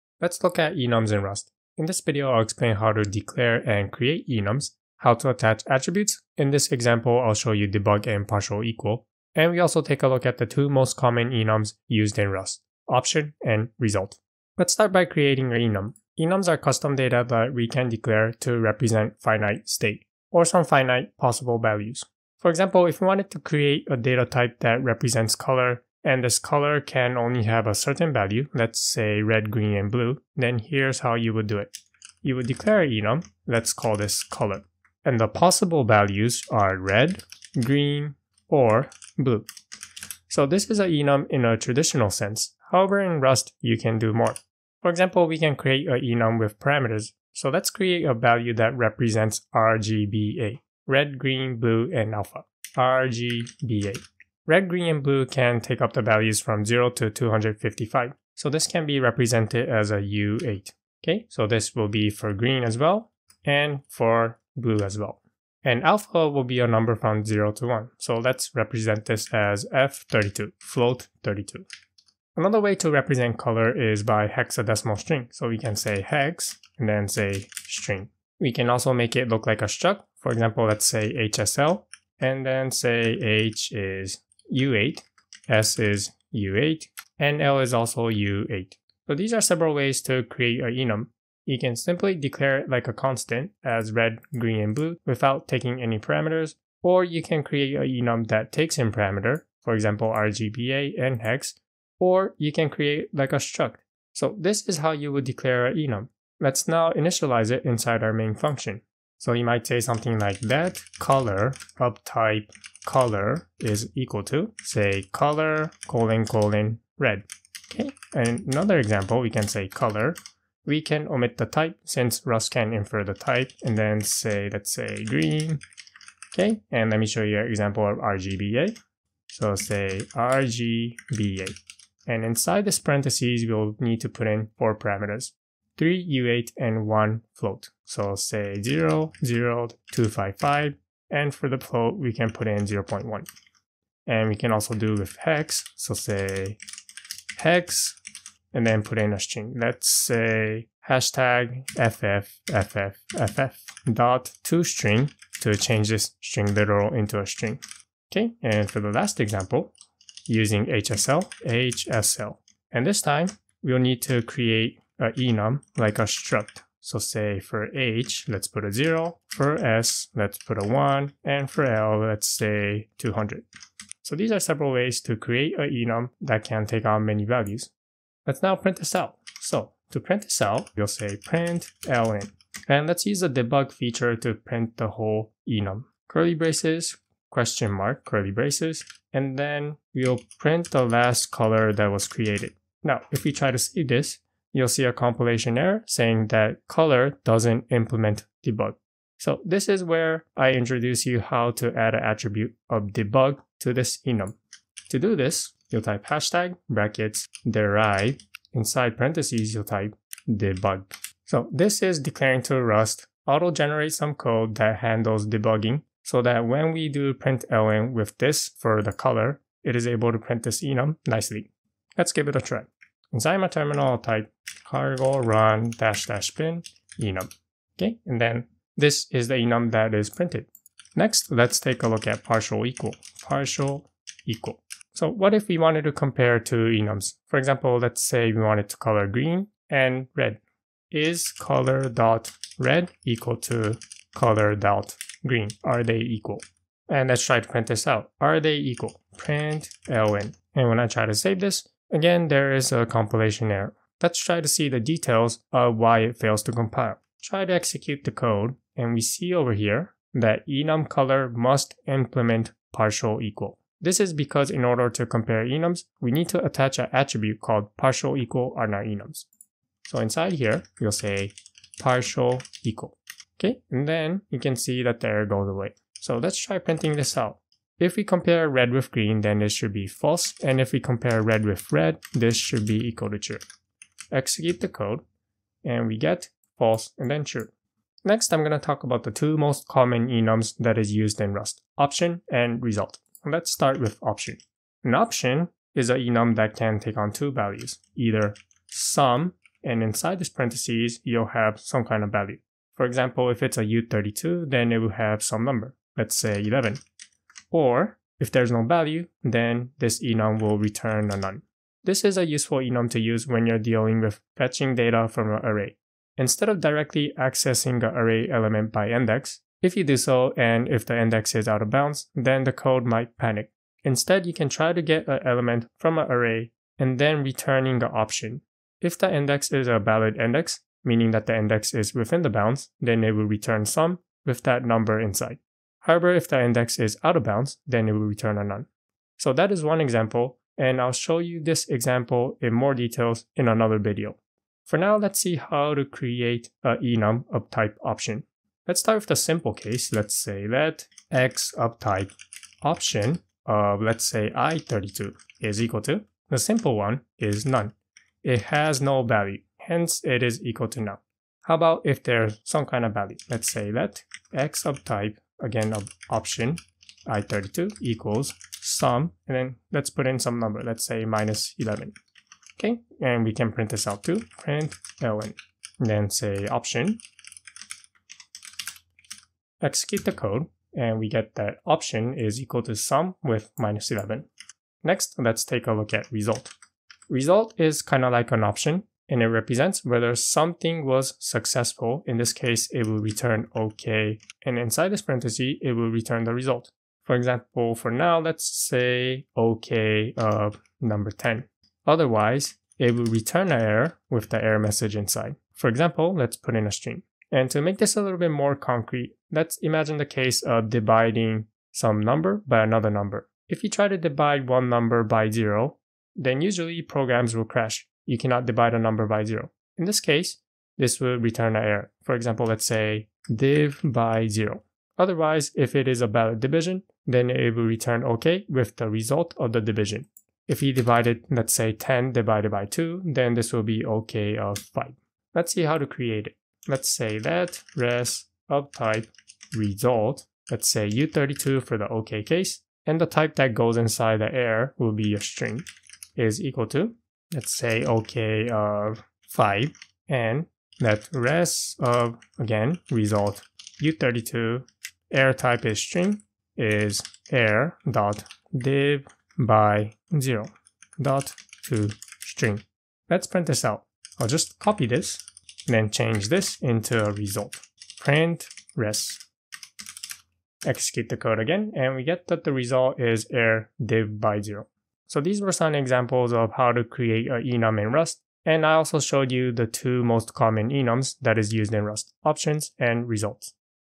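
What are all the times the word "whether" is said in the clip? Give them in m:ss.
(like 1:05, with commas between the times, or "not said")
6:29.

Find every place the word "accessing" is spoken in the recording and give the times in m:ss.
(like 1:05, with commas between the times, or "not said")
5:17.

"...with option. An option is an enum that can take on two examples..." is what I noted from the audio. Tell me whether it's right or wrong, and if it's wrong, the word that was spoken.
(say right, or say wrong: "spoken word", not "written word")
wrong: "values", not "examples".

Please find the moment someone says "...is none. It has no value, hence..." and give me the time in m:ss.
5:57.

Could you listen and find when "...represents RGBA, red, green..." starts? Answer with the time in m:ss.
0:48.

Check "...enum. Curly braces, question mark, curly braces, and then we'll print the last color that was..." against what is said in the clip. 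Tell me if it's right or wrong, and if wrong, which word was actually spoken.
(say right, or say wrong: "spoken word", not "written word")
right.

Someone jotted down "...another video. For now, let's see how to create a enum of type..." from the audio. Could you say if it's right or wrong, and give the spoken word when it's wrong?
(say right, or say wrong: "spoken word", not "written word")
right.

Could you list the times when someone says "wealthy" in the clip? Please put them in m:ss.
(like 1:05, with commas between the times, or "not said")
not said.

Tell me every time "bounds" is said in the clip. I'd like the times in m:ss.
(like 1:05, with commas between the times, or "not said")
5:21, 5:32, 5:37.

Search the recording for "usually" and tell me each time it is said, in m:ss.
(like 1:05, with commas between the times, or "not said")
6:56.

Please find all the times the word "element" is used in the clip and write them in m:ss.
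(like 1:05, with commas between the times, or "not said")
5:18, 5:25.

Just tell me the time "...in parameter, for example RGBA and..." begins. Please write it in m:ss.
1:38.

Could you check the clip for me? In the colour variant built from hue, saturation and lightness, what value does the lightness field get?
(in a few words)
200.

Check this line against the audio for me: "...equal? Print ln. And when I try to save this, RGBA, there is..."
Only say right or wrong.
wrong.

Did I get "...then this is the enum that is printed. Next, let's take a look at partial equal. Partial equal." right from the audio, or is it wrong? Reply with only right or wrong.
right.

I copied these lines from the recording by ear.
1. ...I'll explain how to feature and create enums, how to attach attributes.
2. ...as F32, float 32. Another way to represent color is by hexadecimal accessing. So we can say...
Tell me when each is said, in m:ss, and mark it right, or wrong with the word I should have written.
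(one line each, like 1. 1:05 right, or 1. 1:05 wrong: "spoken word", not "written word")
1. 0:02 wrong: "declare", not "feature"
2. 1:09 wrong: "string", not "accessing".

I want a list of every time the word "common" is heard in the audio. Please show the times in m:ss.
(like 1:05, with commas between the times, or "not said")
0:10, 4:49, 8:00.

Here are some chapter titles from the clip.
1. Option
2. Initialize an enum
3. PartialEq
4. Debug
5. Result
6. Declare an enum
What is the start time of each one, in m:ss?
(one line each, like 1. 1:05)
1. 4:54
2. 1:49
3. 3:50
4. 2:58
5. 6:26
6. 0:15.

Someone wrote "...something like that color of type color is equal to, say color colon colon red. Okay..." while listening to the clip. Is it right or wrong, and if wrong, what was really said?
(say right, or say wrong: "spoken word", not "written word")
right.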